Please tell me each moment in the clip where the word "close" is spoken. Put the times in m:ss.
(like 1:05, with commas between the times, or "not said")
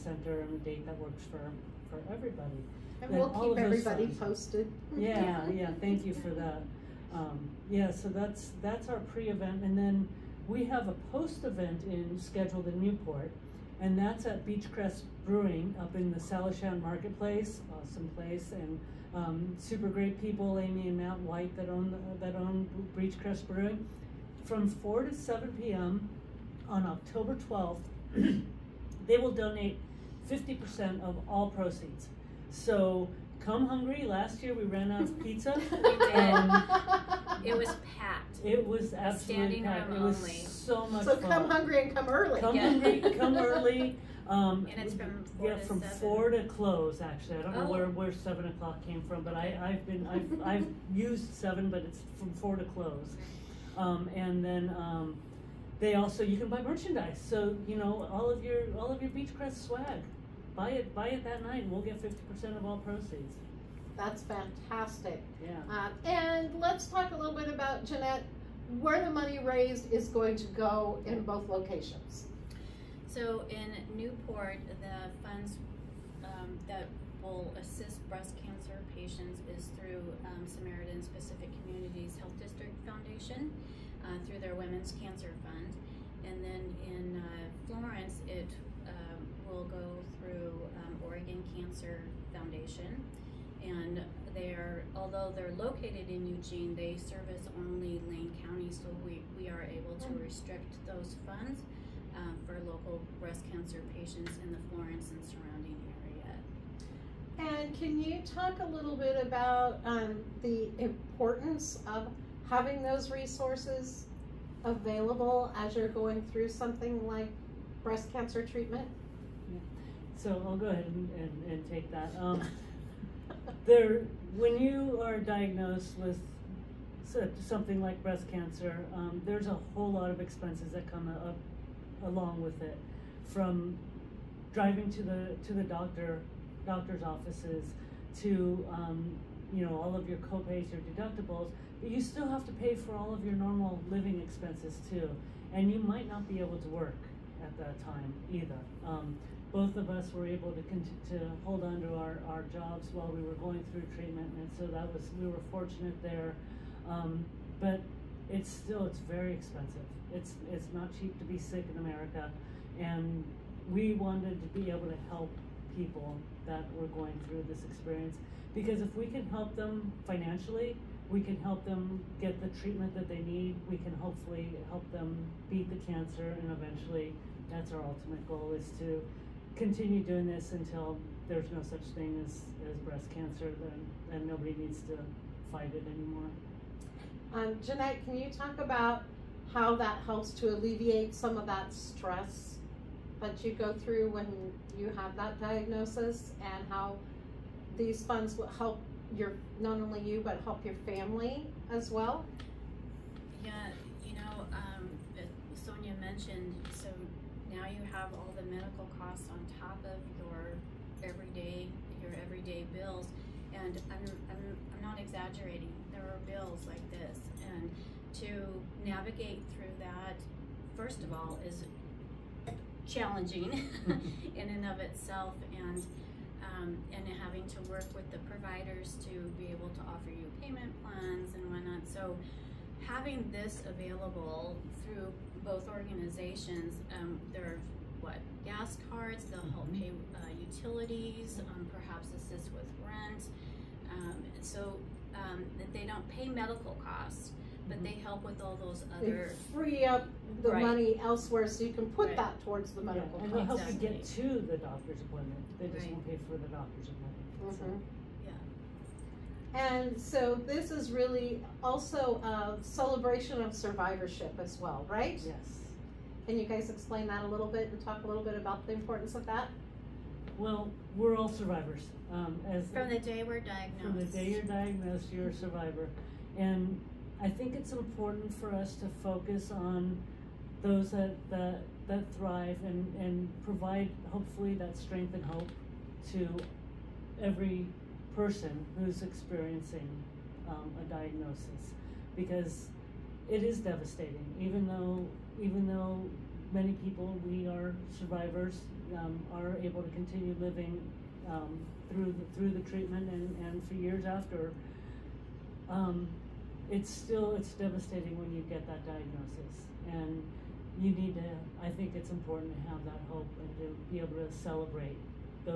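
0:46, 0:52.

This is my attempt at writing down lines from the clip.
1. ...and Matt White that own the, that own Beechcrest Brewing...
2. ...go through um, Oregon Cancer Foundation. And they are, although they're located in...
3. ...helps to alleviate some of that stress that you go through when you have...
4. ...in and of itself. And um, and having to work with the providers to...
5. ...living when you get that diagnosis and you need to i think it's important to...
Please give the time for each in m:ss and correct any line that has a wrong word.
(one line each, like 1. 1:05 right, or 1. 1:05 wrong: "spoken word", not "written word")
1. 0:20 right
2. 1:29 right
3. 3:10 right
4. 3:44 right
5. 5:07 wrong: "devastating", not "living".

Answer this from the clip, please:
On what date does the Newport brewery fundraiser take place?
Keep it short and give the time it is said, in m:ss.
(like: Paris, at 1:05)
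October 12, at 0:26.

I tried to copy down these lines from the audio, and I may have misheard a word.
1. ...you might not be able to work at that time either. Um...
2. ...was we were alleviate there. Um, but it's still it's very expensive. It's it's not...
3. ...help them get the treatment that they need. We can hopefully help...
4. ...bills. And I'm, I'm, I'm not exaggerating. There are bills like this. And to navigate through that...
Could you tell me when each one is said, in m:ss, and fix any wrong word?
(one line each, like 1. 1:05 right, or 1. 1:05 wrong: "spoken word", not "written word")
1. 2:25 right
2. 2:34 wrong: "fortunate", not "alleviate"
3. 2:51 right
4. 3:32 right.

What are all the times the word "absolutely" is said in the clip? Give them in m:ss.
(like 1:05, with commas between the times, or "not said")
0:38.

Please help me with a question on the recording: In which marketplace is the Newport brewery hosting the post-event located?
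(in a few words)
Salishan Marketplace.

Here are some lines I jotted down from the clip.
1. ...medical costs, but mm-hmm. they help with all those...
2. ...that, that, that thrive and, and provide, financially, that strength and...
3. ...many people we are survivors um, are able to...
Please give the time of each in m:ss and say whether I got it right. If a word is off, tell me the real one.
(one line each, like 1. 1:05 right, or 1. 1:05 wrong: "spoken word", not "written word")
1. 4:06 right
2. 4:40 wrong: "hopefully", not "financially"
3. 4:56 right.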